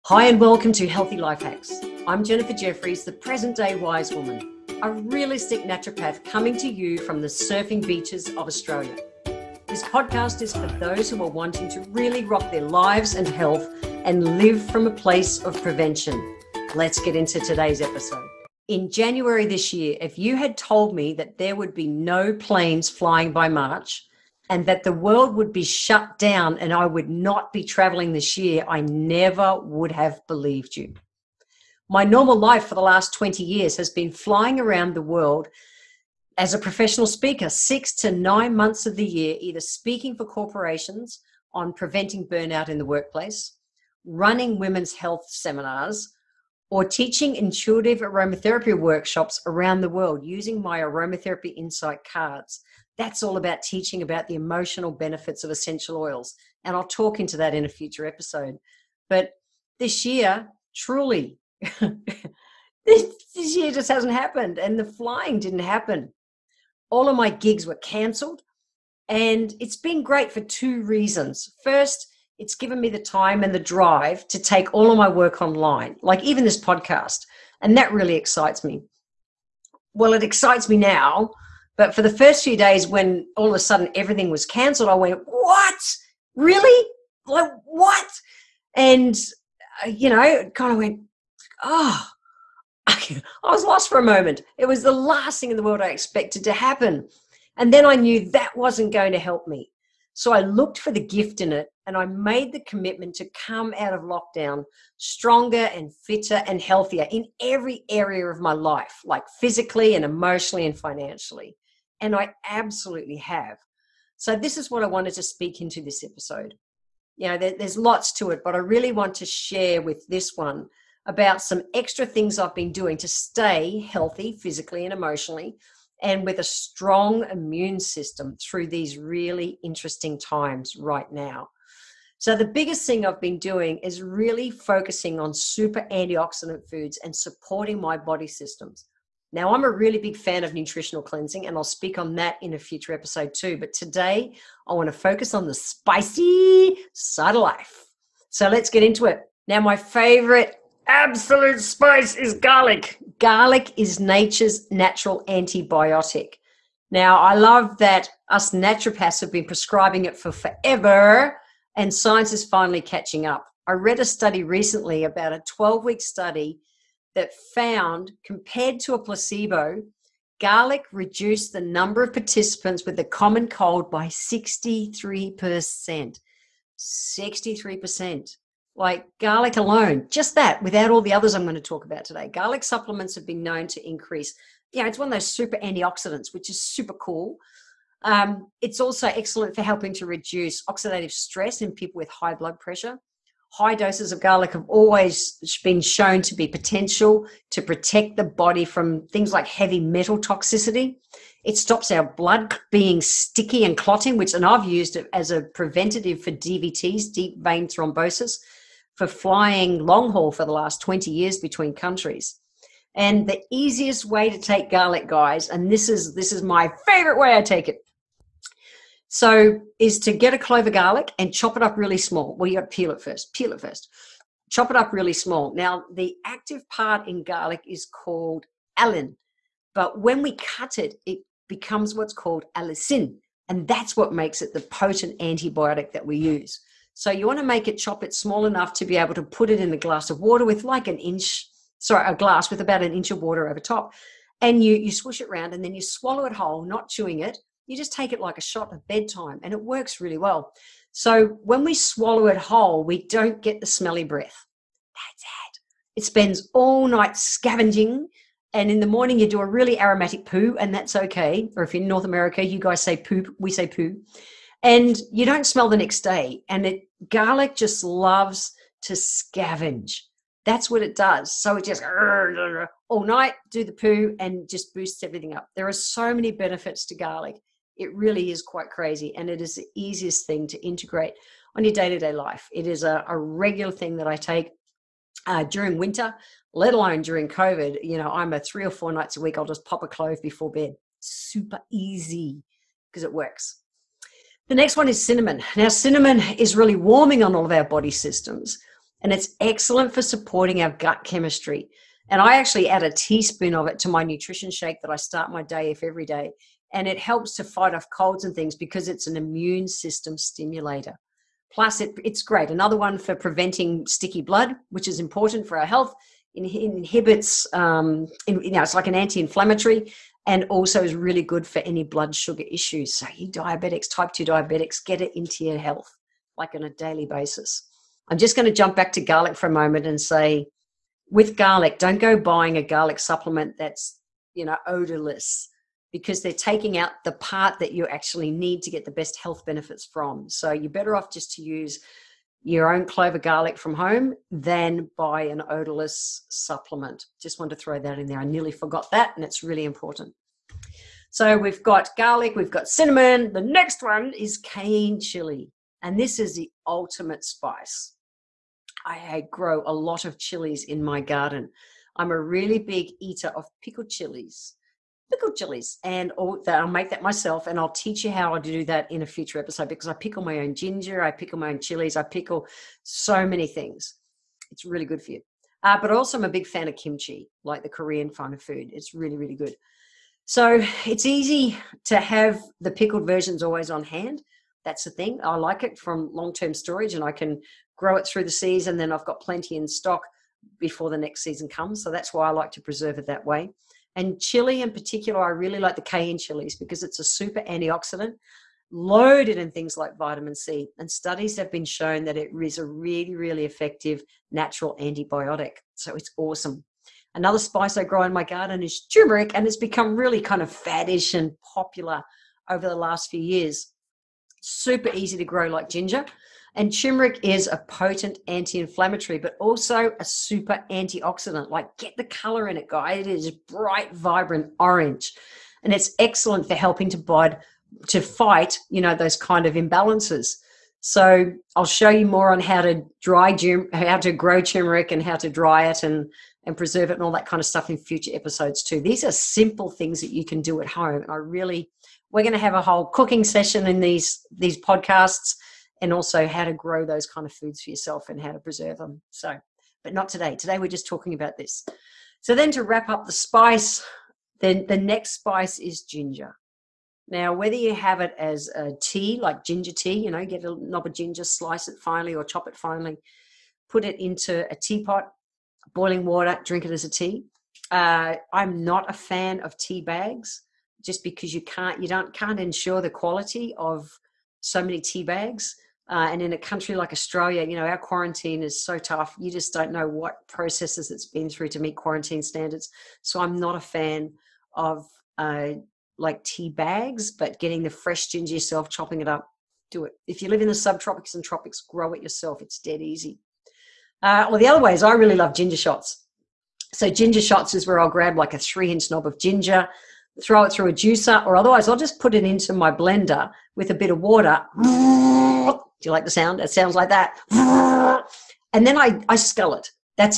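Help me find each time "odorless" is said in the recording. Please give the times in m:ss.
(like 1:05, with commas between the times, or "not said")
5:34, 5:45.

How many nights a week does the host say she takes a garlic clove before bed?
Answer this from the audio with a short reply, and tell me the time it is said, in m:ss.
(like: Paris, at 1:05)
three or four, at 4:48.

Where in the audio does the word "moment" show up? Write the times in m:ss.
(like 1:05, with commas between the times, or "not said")
1:34, 5:29.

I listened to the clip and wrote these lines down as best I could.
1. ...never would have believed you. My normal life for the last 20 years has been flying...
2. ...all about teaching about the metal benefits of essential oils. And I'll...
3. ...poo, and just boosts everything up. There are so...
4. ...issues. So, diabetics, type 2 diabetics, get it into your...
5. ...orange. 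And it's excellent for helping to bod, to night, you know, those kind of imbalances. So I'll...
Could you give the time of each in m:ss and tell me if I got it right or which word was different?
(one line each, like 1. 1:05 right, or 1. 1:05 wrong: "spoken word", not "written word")
1. 0:28 right
2. 0:53 wrong: "emotional", not "metal"
3. 4:33 right
4. 5:22 right
5. 7:04 wrong: "fight", not "night".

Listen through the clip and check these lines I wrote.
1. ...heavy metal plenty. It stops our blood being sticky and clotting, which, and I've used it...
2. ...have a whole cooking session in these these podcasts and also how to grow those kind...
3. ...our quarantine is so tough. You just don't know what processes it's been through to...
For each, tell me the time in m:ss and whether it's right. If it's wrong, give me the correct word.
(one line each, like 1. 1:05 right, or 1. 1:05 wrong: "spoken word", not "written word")
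1. 3:19 wrong: "toxicity", not "plenty"
2. 7:22 right
3. 7:57 right.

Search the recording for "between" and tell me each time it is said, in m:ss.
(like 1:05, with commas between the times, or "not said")
3:31.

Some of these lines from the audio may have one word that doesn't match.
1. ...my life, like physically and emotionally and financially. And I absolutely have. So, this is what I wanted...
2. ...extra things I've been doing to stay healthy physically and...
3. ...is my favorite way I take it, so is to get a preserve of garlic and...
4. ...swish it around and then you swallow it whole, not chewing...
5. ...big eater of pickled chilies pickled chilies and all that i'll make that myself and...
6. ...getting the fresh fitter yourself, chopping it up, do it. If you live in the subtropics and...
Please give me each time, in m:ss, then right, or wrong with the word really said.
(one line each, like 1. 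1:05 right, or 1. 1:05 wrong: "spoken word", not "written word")
1. 1:48 right
2. 2:01 right
3. 3:36 wrong: "clove", not "preserve"
4. 4:04 right
5. 6:02 right
6. 8:07 wrong: "ginger", not "fitter".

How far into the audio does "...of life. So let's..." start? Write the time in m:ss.
2:27.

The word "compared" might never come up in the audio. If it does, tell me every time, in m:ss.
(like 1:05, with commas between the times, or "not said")
2:48.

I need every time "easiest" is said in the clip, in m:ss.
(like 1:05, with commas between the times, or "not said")
3:33, 4:39.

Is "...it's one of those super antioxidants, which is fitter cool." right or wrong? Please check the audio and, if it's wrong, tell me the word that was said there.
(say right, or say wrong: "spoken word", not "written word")
wrong: "super", not "fitter".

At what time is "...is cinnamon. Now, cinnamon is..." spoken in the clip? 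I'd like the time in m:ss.
4:54.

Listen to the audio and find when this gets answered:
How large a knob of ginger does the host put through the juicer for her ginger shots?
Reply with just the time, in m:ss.
8:18.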